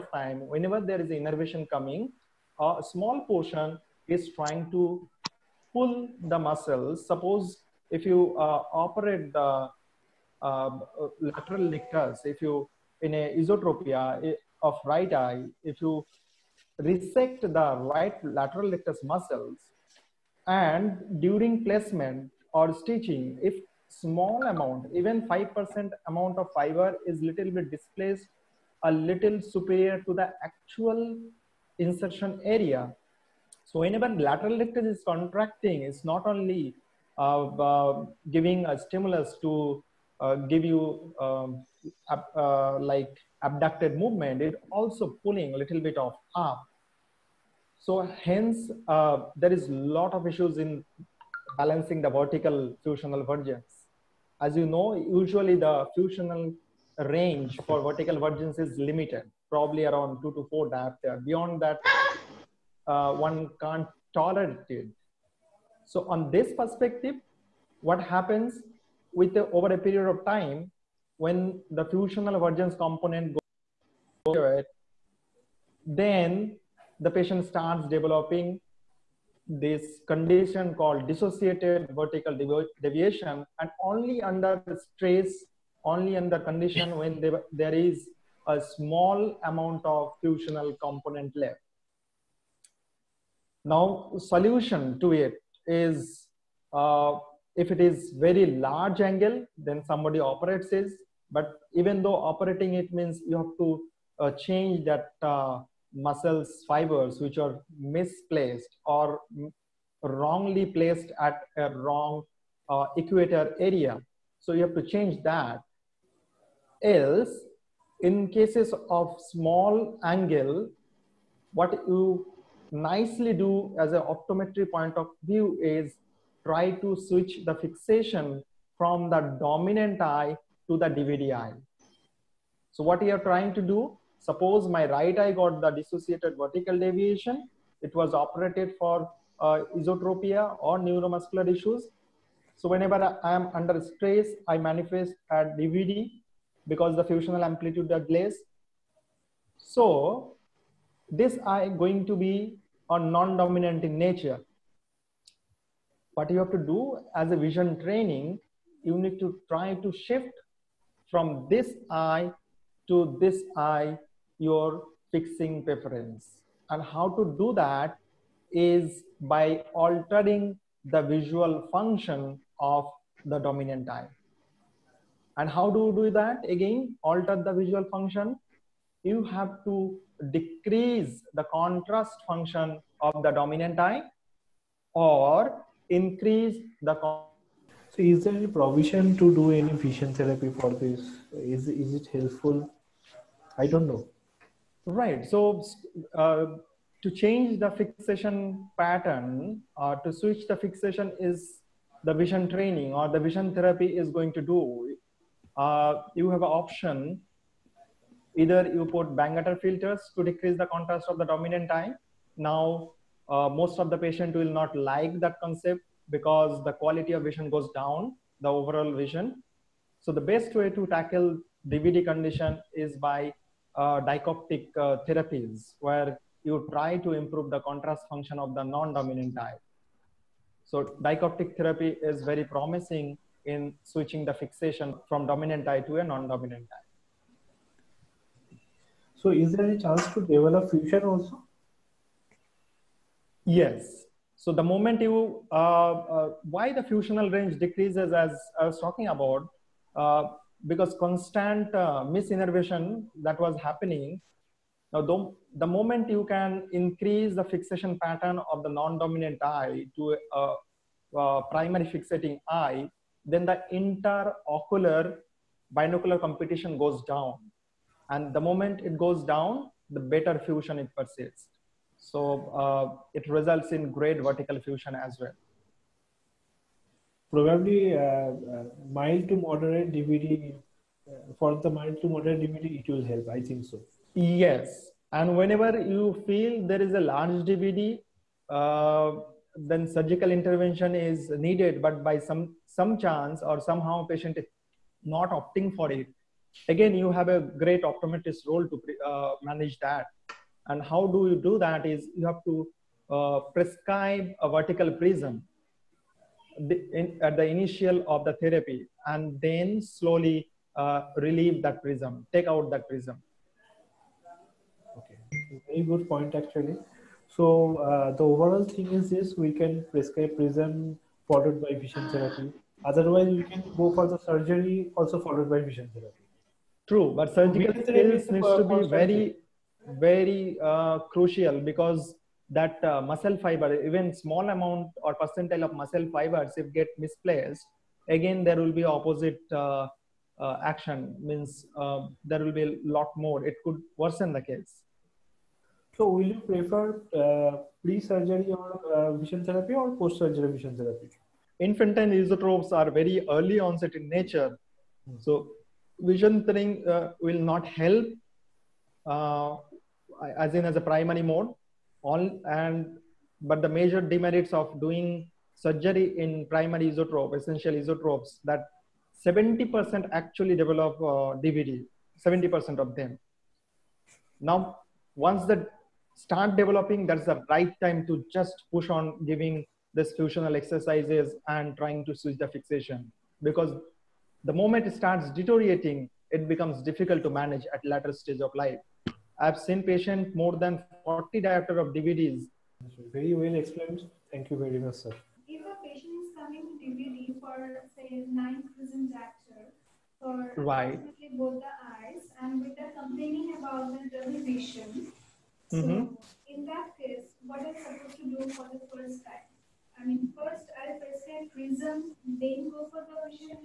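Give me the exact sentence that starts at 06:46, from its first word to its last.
So in that case, what am supposed to do for the first time?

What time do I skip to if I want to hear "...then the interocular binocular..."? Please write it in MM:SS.
04:23.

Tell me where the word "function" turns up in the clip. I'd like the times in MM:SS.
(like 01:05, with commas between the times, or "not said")
02:51, 02:57, 03:02, 03:48.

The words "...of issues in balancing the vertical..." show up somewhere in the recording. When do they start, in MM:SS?
00:50.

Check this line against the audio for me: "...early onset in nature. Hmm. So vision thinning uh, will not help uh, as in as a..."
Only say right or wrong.
right.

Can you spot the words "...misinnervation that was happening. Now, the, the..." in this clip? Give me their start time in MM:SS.
04:12.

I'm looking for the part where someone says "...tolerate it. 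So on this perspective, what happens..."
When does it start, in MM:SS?
01:04.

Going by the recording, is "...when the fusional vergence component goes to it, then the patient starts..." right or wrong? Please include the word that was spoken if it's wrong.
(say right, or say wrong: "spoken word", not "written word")
right.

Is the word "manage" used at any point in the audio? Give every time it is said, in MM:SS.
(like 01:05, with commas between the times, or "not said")
04:59, 06:27.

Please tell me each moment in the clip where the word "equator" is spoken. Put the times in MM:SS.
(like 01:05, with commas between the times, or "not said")
01:52.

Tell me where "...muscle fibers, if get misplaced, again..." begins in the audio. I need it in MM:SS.
05:35.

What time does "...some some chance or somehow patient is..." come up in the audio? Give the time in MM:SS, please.
04:52.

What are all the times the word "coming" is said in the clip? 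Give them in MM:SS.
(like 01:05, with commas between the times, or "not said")
00:01, 06:36.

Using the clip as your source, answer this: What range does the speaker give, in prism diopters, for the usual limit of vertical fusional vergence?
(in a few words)
2 to 4 diopters.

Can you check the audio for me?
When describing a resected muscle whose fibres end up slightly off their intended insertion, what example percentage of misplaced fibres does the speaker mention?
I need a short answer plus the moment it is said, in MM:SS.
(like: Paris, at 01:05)
5%, at 00:25.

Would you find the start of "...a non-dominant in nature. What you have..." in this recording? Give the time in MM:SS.
02:32.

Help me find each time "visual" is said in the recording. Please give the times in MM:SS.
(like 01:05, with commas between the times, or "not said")
02:51, 02:57.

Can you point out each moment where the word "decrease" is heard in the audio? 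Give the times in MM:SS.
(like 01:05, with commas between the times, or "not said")
03:00, 03:30, 04:07.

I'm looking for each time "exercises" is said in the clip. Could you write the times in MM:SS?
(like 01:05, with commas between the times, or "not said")
06:20.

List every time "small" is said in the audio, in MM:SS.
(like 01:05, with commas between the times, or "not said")
00:02, 00:23, 01:28, 01:59, 05:34.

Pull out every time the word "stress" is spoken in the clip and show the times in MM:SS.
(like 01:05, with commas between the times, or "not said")
01:24, 02:23.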